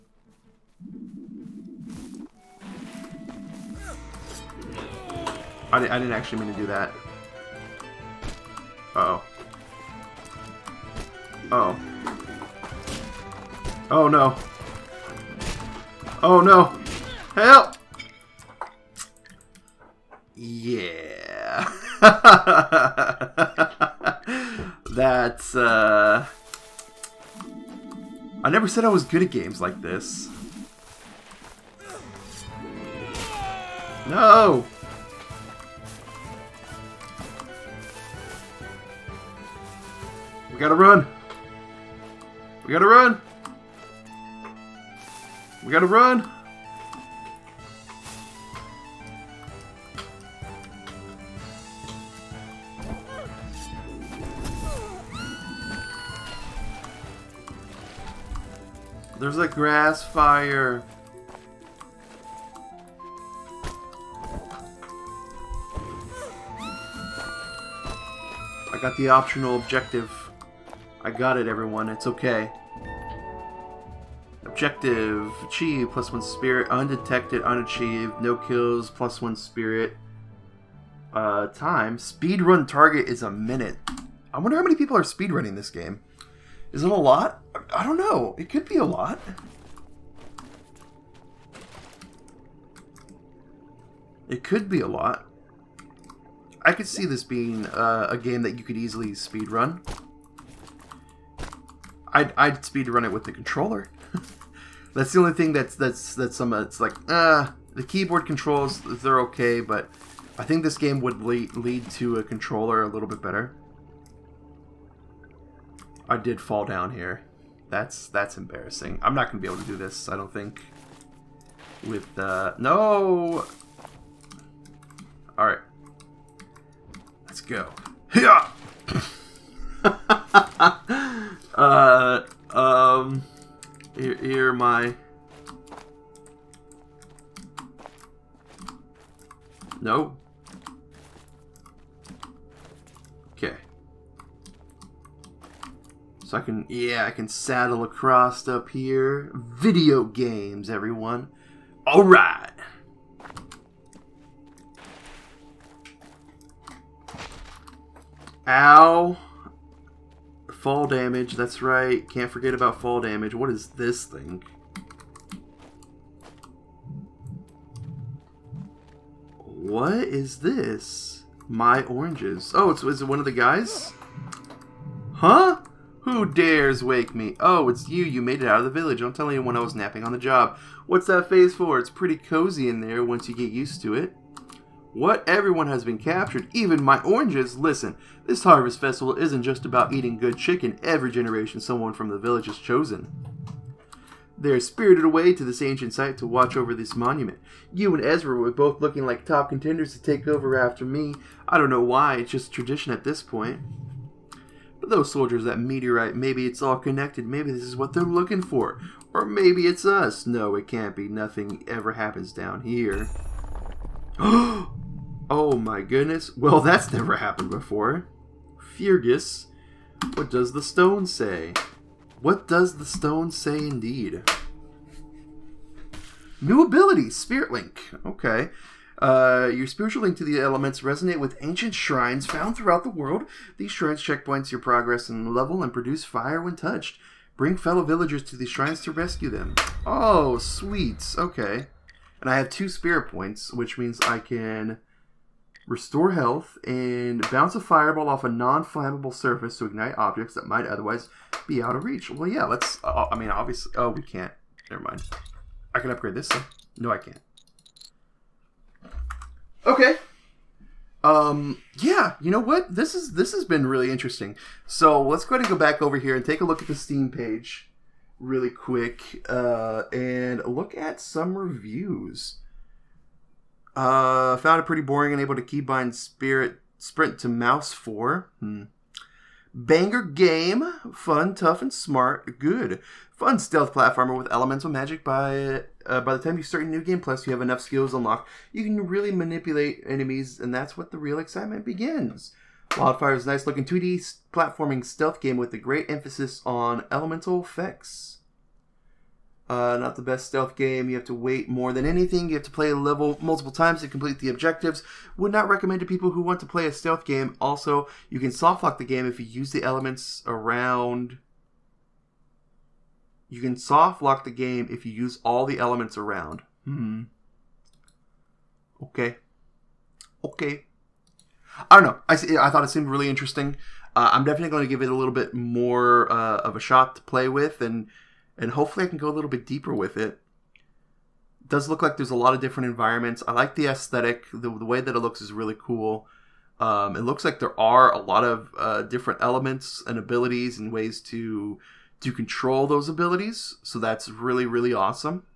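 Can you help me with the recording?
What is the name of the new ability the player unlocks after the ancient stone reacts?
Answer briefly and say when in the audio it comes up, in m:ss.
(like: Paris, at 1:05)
Spirit Link, at 3:47.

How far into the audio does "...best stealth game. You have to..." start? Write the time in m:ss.
5:00.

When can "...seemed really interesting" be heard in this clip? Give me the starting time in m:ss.
5:22.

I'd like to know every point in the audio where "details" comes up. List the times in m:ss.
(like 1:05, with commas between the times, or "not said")
not said.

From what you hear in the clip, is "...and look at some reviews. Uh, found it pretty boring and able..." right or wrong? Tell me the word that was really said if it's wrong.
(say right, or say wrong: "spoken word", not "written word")
right.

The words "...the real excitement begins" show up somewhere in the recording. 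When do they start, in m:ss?
4:50.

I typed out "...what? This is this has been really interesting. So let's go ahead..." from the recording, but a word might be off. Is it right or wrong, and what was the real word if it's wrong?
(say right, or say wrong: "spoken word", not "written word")
right.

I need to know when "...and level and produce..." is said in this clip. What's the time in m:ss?
3:55.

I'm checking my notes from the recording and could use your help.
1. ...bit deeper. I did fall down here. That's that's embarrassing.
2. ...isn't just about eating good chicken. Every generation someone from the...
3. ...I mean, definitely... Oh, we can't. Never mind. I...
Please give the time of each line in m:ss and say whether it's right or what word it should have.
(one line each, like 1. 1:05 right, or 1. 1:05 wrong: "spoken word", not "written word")
1. 1:53 wrong: "better", not "deeper"
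2. 3:09 right
3. 4:13 wrong: "obviously", not "definitely".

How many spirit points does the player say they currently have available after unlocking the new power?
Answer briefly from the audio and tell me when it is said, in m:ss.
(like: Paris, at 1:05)
2, at 4:02.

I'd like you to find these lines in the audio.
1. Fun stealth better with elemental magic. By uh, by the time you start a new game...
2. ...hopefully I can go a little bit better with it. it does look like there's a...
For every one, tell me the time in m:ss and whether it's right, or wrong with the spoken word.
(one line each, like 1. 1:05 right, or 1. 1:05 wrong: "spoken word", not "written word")
1. 4:43 wrong: "platformer", not "better"
2. 5:28 wrong: "deeper", not "better".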